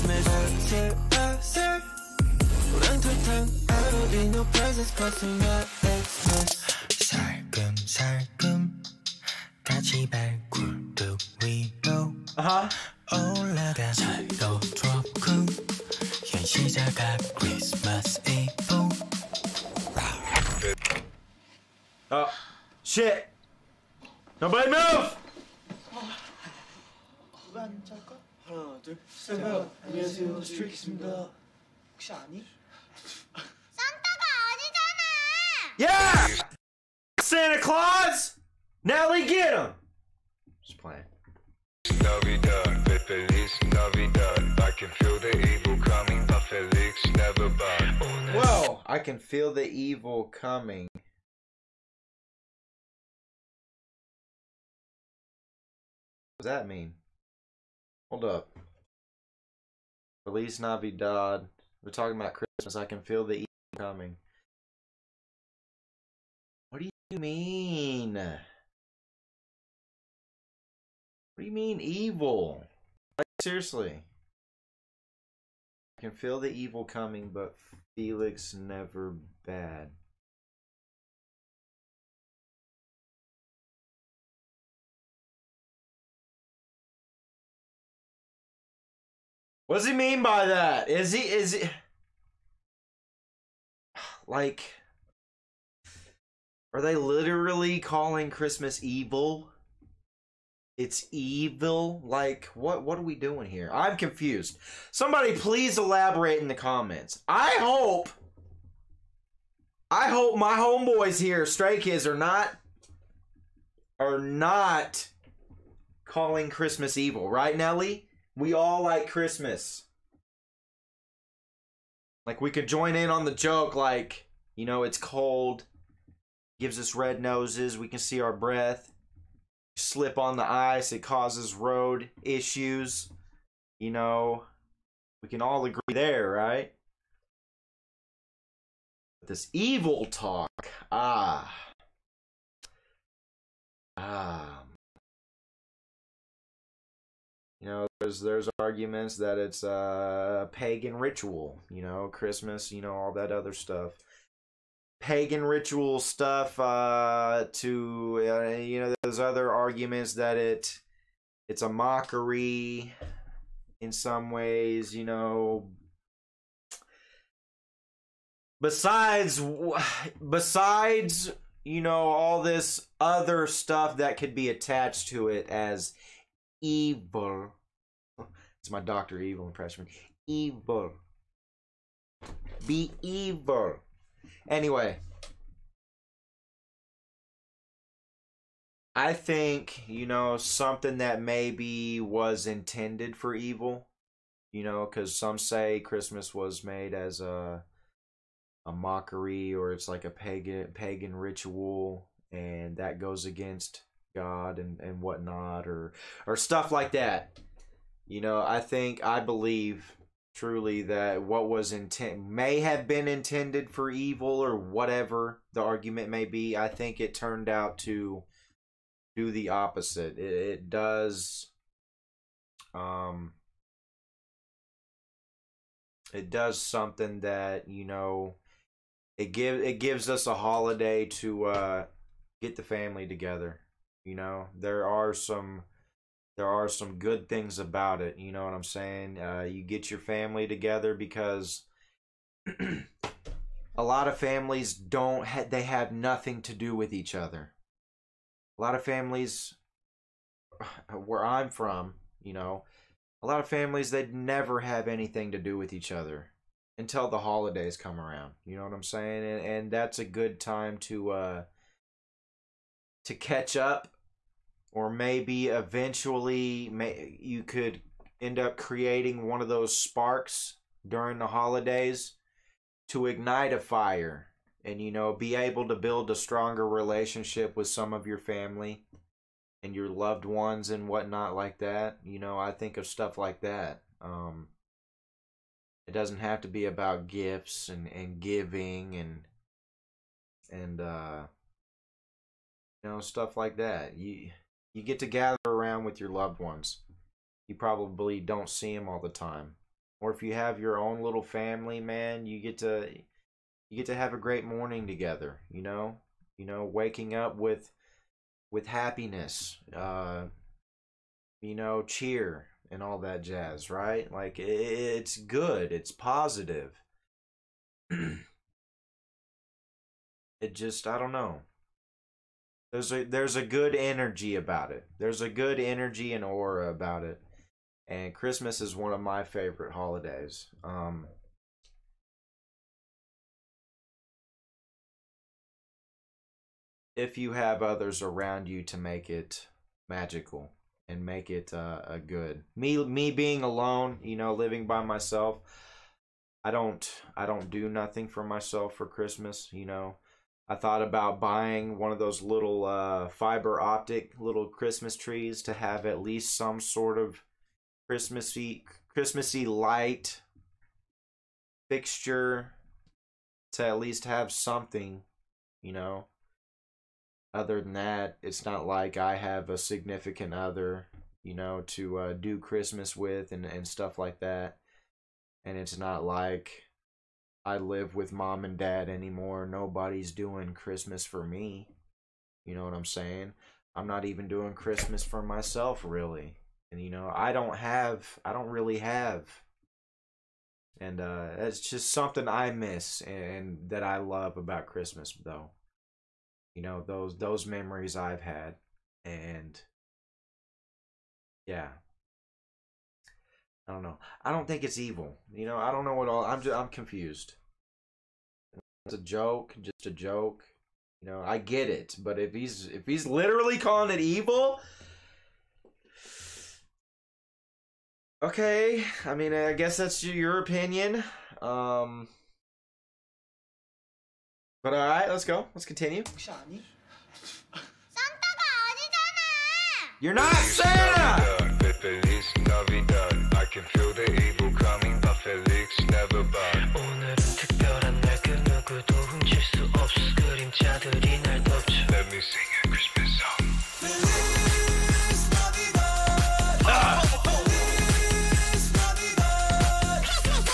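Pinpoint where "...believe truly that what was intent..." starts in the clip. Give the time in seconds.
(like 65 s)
209 s.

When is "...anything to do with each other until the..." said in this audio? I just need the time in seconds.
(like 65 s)
254 s.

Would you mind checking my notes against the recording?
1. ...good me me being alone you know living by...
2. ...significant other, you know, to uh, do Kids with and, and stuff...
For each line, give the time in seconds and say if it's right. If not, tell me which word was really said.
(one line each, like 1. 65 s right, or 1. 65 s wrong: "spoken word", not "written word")
1. 341 s right
2. 369 s wrong: "Christmas", not "Kids".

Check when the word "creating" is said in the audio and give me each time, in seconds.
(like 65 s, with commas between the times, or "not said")
268 s.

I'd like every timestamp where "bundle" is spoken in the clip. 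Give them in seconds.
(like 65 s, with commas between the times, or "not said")
not said.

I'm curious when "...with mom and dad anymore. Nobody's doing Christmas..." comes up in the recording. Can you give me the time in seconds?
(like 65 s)
377 s.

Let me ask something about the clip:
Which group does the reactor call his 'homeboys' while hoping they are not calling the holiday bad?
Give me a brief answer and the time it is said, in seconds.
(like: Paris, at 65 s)
Stray Kids, at 111 s.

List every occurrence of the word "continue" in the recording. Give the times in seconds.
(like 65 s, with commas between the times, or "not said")
425 s.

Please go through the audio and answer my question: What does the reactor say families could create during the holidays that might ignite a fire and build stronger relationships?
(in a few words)
sparks.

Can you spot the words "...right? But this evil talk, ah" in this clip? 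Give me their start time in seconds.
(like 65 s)
136 s.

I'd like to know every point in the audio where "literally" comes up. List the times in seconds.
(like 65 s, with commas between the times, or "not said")
96 s, 413 s.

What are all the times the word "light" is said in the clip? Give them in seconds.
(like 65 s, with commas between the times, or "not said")
359 s.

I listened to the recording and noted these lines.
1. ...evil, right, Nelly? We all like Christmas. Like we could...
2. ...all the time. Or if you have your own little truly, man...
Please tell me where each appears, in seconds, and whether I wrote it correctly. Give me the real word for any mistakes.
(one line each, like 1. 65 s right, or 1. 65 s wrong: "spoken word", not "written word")
1. 116 s right
2. 298 s wrong: "family", not "truly".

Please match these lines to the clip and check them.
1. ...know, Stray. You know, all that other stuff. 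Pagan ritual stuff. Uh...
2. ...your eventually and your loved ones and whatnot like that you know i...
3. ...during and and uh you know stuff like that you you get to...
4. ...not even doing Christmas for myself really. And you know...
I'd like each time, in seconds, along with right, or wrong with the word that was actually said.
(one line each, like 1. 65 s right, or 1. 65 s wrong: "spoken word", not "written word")
1. 151 s wrong: "Christmas", not "Stray"
2. 278 s wrong: "family", not "eventually"
3. 288 s wrong: "giving", not "during"
4. 383 s right.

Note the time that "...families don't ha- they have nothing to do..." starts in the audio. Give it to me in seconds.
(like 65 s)
244 s.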